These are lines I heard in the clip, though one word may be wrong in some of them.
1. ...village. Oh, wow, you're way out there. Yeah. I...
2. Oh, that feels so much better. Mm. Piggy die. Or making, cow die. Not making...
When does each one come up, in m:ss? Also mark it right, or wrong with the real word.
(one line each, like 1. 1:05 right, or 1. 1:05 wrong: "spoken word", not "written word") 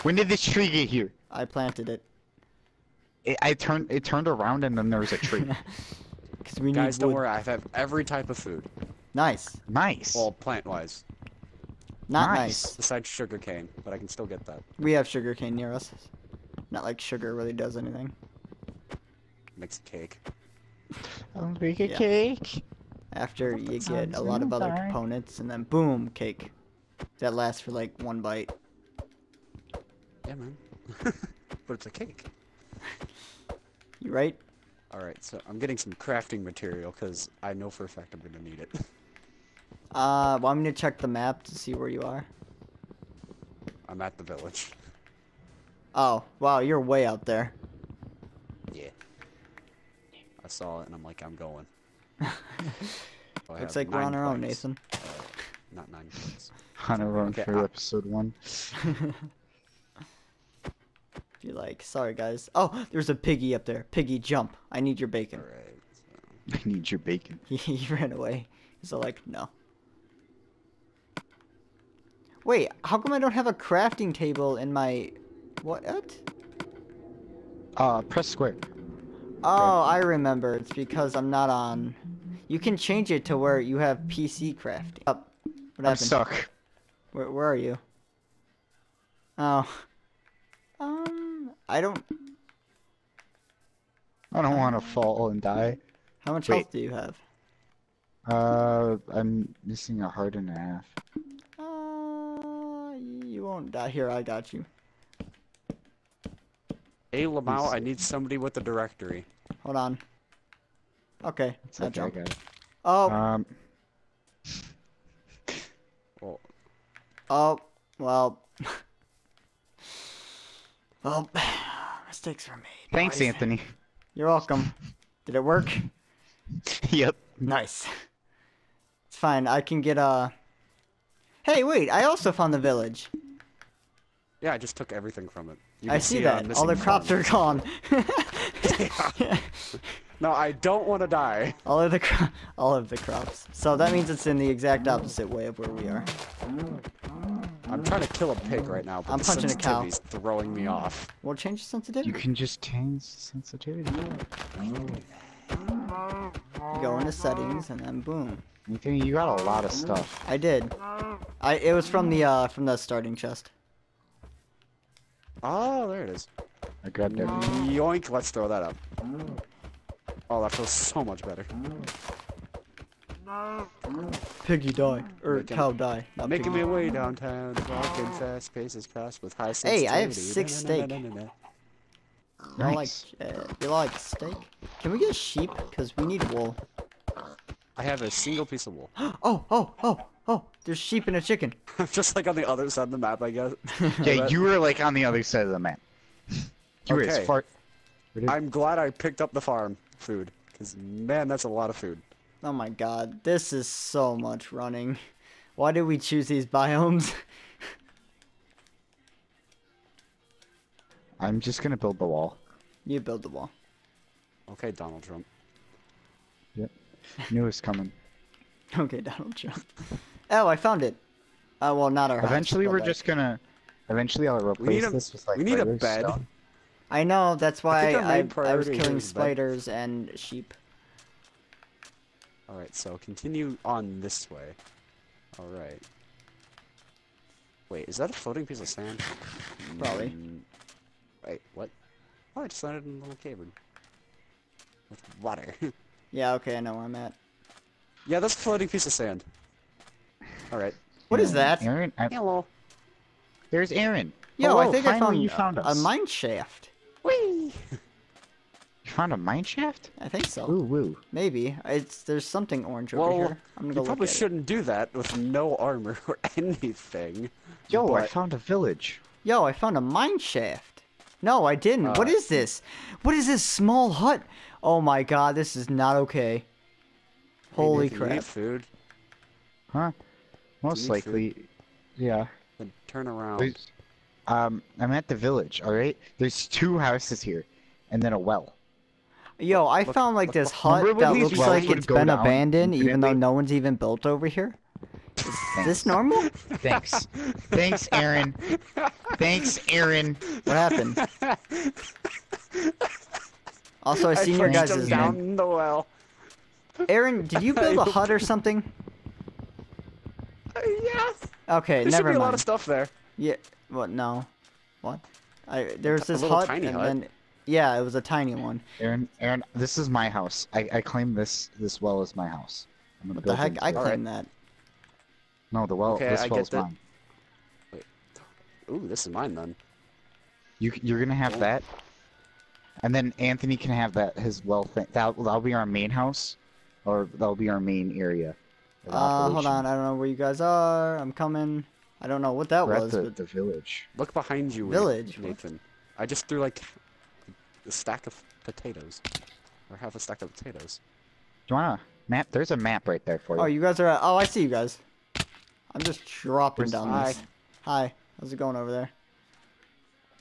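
1. 0:44 right
2. 2:50 right.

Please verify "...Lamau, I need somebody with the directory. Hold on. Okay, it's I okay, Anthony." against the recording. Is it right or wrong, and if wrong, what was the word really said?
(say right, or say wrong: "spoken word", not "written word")
wrong: "Guys", not "Anthony".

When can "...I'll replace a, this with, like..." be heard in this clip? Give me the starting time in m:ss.
3:44.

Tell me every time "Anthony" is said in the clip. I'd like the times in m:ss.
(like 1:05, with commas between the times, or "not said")
2:03, 5:33.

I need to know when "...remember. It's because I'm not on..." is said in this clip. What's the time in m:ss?
1:19.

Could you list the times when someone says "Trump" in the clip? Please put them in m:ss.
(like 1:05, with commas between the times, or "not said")
3:35, 3:39.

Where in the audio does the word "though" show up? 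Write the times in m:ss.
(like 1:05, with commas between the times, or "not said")
4:52.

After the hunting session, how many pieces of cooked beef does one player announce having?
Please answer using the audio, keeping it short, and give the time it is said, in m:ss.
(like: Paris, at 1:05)
6, at 3:00.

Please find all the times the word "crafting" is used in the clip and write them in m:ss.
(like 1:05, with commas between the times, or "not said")
0:35, 1:13, 1:24.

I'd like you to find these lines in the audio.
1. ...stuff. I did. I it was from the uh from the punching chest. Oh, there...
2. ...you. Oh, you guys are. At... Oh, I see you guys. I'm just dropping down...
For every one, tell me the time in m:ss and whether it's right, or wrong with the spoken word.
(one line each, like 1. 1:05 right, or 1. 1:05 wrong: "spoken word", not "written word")
1. 2:39 wrong: "starting", not "punching"
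2. 5:53 right.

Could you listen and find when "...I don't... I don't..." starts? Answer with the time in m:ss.
1:31.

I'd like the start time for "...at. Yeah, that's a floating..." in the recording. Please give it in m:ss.
4:06.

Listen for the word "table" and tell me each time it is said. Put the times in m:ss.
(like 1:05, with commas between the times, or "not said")
1:14.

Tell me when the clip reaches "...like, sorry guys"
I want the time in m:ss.
1:01.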